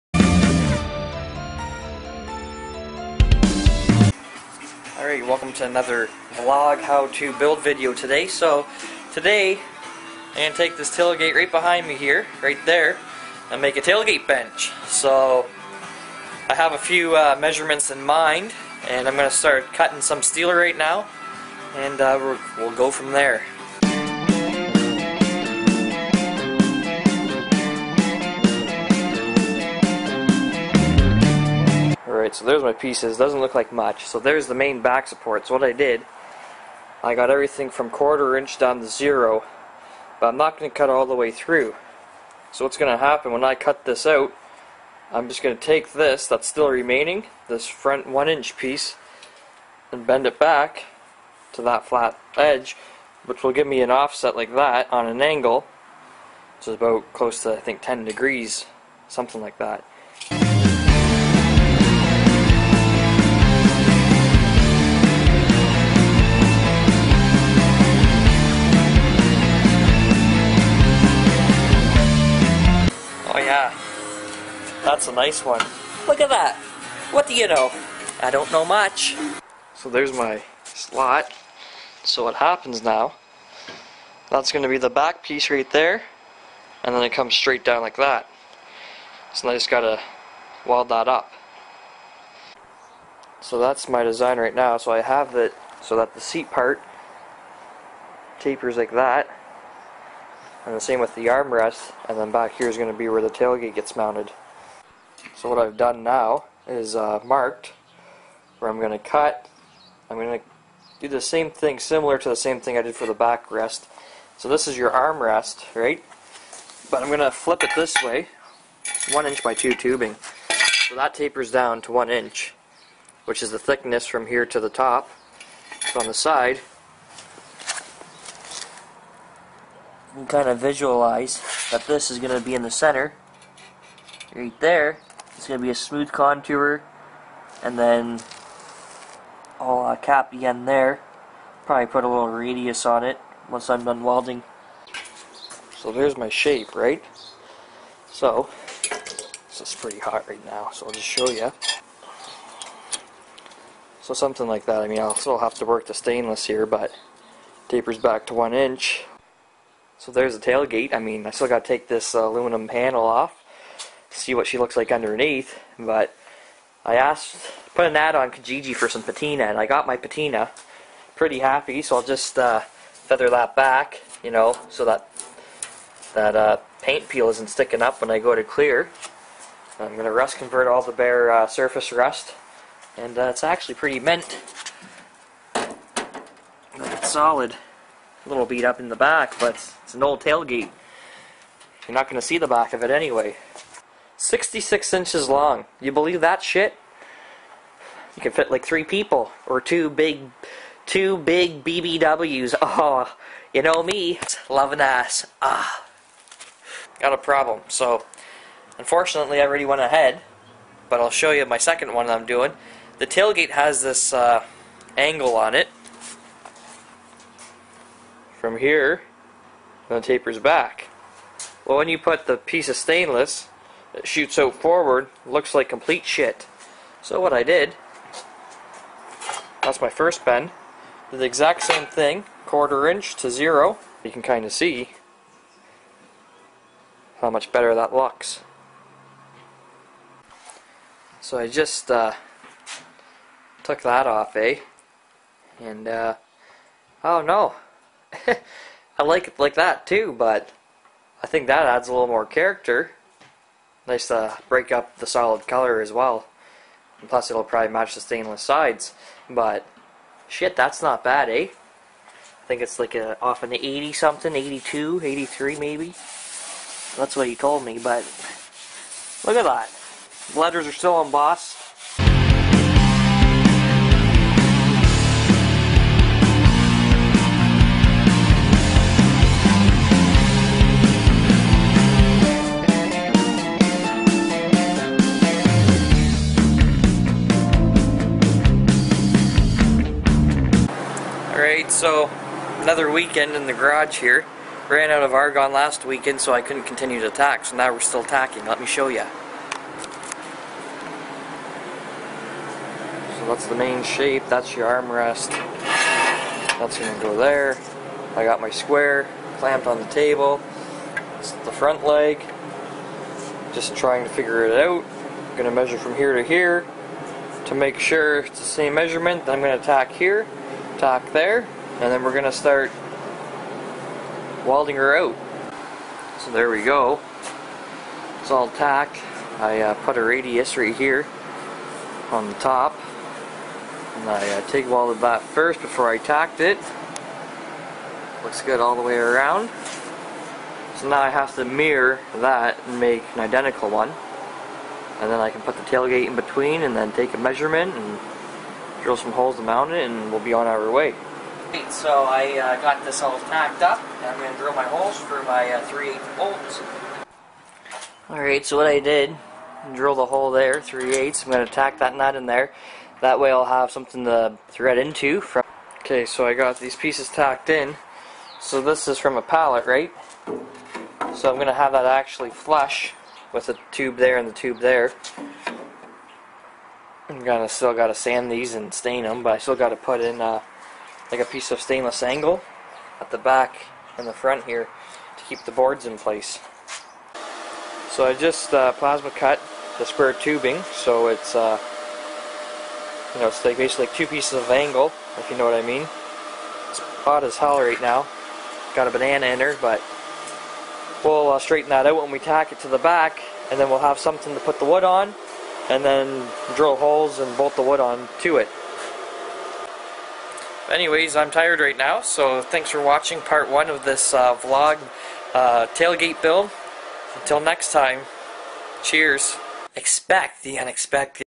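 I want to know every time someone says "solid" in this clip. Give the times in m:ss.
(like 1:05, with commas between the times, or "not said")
3:07, 4:15.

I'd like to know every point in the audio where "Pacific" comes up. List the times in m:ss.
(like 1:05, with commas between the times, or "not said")
not said.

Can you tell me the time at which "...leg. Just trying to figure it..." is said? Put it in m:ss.
5:11.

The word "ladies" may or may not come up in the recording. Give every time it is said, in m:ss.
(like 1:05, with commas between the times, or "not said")
not said.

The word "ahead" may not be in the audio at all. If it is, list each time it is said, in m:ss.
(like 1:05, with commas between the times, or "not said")
3:29.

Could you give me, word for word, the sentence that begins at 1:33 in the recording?
So that's my design right now.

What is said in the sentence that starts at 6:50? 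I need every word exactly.
Anyways, I'm tired right now, so thanks for watching part one of this uh, vlog uh, tailgate build.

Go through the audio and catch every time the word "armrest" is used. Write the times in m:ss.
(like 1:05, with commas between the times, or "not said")
1:41, 1:54, 5:04.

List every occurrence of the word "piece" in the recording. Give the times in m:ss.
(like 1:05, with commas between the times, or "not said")
0:32, 0:48, 1:25, 3:42, 6:06, 6:21, 6:34.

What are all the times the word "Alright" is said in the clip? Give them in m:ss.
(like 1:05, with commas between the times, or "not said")
0:05, 4:51, 5:58.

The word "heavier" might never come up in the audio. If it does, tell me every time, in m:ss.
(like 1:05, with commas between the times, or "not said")
not said.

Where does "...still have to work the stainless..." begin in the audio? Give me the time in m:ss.
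2:35.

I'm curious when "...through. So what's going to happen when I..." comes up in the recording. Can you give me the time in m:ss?
0:41.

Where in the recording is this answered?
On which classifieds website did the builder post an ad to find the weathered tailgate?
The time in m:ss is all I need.
2:48.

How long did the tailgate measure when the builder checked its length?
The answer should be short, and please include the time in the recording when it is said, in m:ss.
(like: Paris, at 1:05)
66 inches, at 3:14.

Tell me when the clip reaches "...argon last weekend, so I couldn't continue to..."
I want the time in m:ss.
4:55.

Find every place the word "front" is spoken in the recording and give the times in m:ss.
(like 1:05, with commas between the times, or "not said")
0:47, 5:11, 6:24.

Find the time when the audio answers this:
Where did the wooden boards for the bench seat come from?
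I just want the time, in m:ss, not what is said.
6:09.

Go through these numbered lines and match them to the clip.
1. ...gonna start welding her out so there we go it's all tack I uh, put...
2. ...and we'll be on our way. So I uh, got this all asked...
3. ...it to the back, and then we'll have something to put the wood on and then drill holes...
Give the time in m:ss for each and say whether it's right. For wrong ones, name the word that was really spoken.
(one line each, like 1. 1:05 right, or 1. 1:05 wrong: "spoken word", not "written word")
1. 5:22 right
2. 5:49 wrong: "packed", not "asked"
3. 6:42 right.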